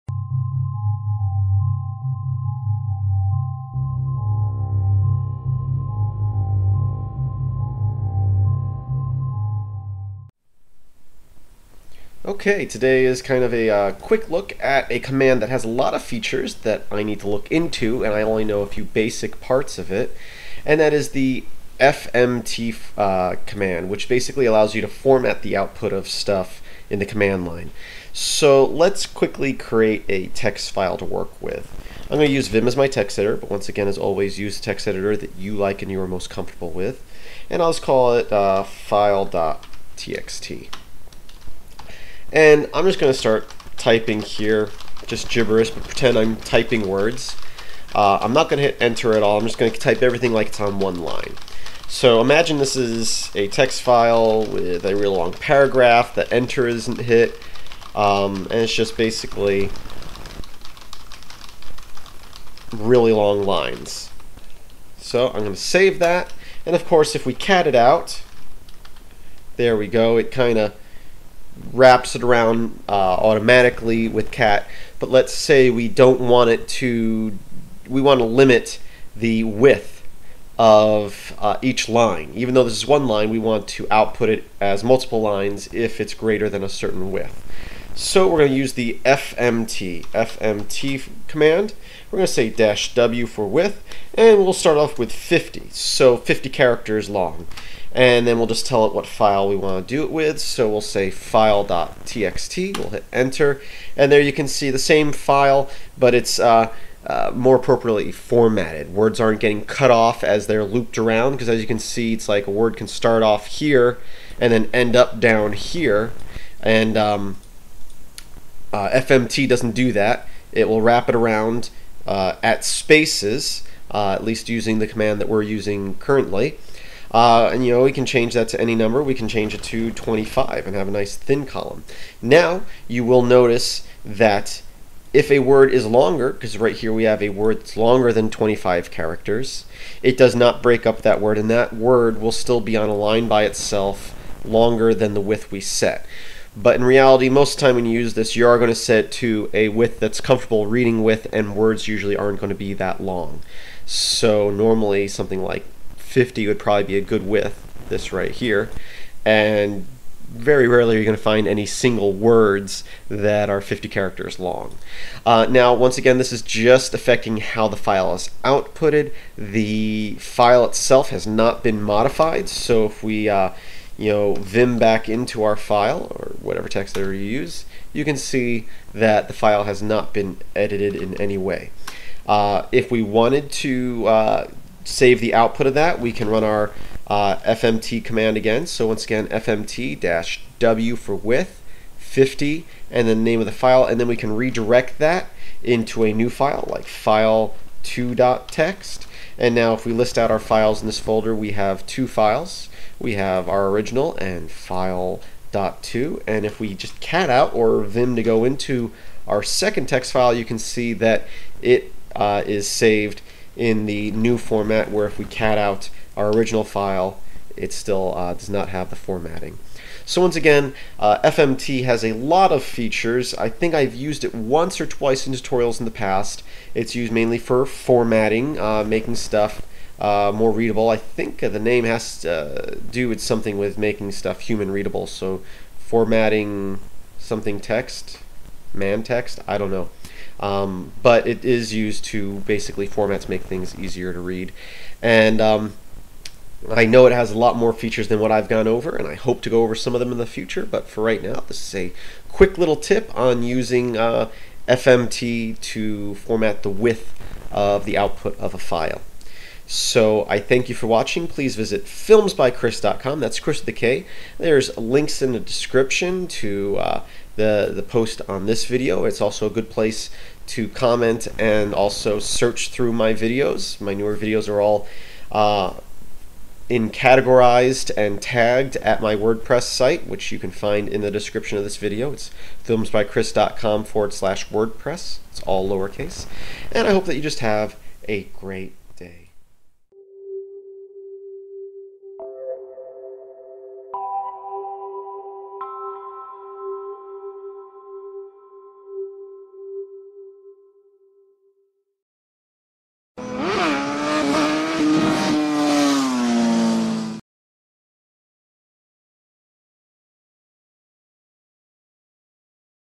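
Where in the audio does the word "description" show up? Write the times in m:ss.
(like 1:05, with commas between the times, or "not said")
4:25, 4:41.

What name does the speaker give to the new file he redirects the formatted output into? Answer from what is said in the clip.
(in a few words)
file2.txt.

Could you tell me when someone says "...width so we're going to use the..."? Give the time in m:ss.
1:27.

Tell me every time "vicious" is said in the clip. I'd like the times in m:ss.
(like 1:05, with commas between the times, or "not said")
not said.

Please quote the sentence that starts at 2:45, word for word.
Uh, now, once again, this is just affecting how the file is outputted.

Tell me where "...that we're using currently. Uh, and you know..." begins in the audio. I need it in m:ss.
2:05.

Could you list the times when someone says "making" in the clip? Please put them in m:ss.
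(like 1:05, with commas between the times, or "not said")
3:48, 3:53.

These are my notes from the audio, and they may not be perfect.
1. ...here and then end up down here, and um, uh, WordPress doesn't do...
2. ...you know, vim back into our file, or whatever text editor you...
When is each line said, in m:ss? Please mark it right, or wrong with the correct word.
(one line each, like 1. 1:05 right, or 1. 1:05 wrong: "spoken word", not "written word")
1. 1:53 wrong: "FMT", not "WordPress"
2. 2:53 right.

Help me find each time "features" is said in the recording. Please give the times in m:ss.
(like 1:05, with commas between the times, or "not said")
0:16, 3:42, 4:07.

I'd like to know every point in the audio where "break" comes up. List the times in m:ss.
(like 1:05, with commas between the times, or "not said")
2:20.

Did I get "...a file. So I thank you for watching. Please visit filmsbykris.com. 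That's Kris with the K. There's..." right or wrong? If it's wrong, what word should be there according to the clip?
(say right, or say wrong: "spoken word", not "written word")
right.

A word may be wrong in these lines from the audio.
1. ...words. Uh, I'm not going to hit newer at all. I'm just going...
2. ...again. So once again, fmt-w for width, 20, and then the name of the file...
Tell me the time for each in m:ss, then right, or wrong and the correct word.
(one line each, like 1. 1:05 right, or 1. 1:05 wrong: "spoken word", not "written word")
1. 0:46 wrong: "enter", not "newer"
2. 3:08 wrong: "50", not "20".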